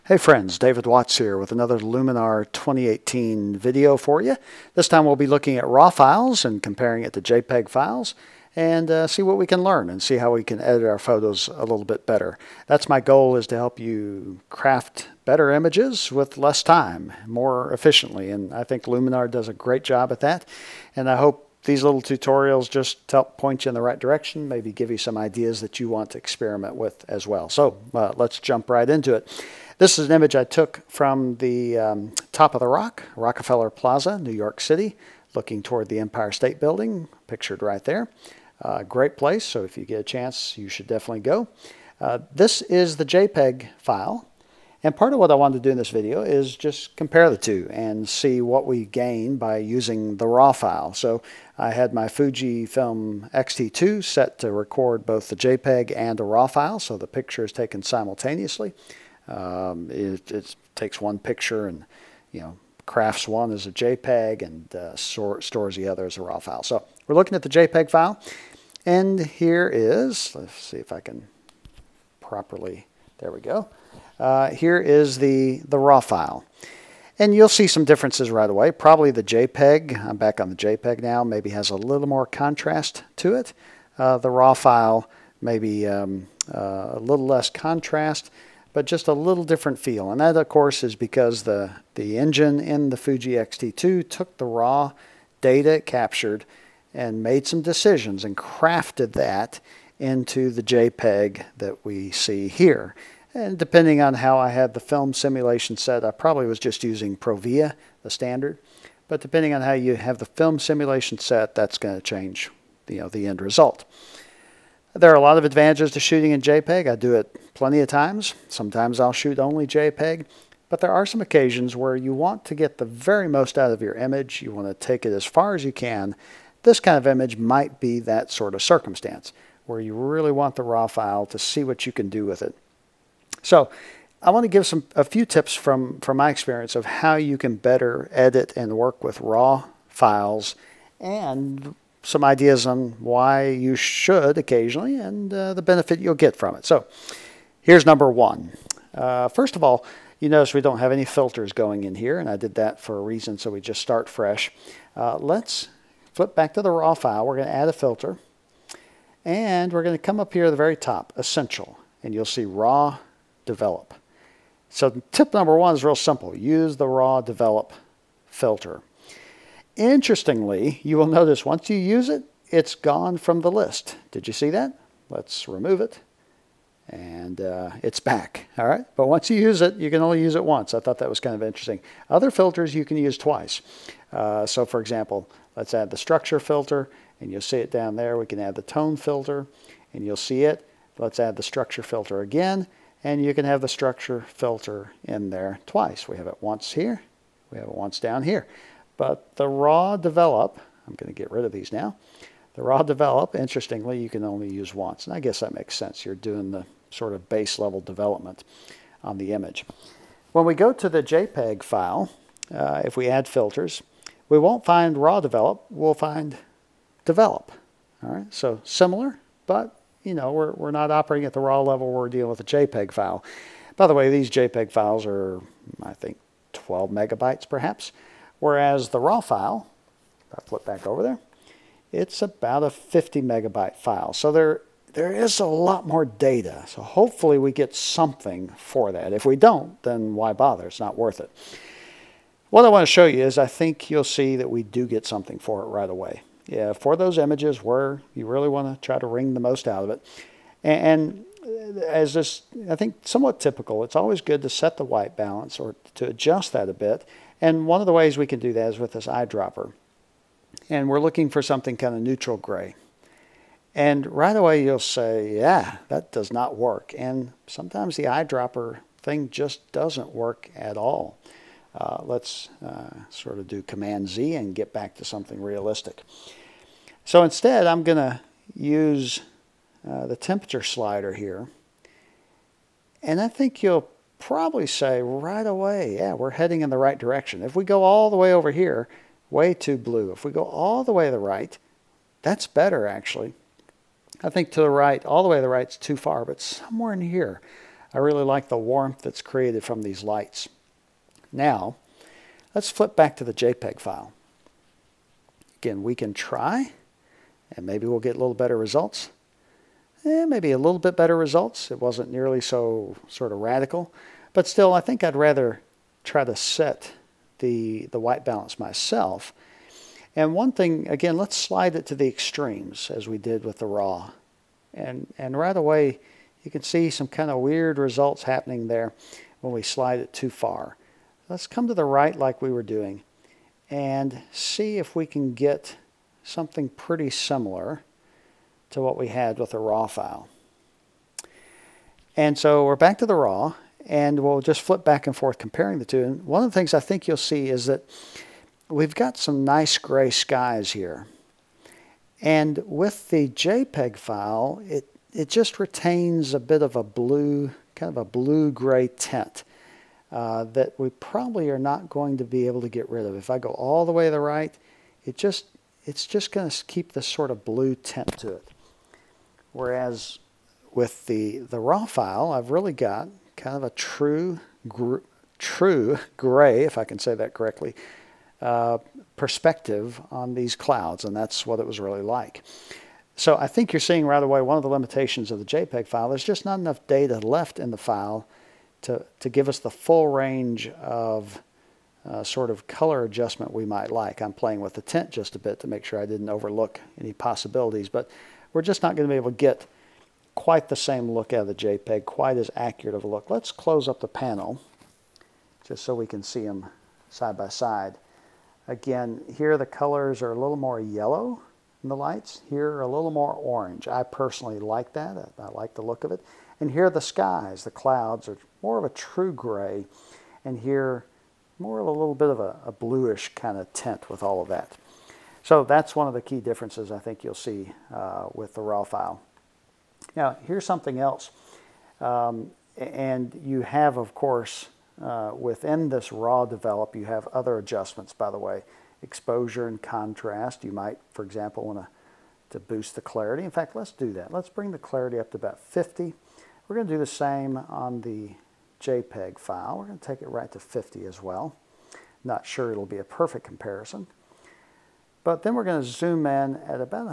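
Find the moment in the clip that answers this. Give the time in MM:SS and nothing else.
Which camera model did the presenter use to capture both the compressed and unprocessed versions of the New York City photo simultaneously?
00:52.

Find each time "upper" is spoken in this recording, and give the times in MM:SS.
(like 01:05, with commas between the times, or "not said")
not said.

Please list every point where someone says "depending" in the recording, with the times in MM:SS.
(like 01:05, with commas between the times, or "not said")
01:43, 01:49.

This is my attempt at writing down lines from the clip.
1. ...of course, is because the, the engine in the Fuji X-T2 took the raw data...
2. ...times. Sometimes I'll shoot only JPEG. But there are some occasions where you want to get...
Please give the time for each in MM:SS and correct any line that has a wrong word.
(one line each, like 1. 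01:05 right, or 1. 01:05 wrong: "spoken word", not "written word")
1. 01:30 right
2. 01:57 right.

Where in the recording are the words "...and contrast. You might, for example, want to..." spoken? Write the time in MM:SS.
07:19.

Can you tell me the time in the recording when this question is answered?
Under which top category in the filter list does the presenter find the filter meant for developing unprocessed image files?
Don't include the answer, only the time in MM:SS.
02:41.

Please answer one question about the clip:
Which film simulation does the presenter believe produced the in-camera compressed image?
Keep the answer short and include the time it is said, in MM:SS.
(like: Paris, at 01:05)
Provia, at 01:47.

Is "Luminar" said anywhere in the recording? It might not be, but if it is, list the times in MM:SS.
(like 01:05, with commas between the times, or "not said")
00:01, 00:18.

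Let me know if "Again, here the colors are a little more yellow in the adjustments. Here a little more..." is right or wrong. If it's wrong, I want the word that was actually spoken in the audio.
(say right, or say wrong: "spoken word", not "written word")
wrong: "lights", not "adjustments".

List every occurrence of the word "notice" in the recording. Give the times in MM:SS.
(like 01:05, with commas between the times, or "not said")
02:30, 02:51.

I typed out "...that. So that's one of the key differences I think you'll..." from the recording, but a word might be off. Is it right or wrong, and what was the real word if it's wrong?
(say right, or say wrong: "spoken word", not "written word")
right.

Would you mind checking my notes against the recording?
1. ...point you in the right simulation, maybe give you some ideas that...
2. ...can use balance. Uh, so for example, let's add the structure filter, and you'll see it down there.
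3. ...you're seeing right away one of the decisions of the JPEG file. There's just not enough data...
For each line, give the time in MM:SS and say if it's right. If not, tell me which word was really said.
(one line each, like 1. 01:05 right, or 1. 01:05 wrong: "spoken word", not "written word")
1. 00:23 wrong: "direction", not "simulation"
2. 03:02 wrong: "twice", not "balance"
3. 06:23 wrong: "limitations", not "decisions".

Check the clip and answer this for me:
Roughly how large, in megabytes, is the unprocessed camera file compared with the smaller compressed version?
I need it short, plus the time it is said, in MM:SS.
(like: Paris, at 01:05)
50 megabytes, at 03:52.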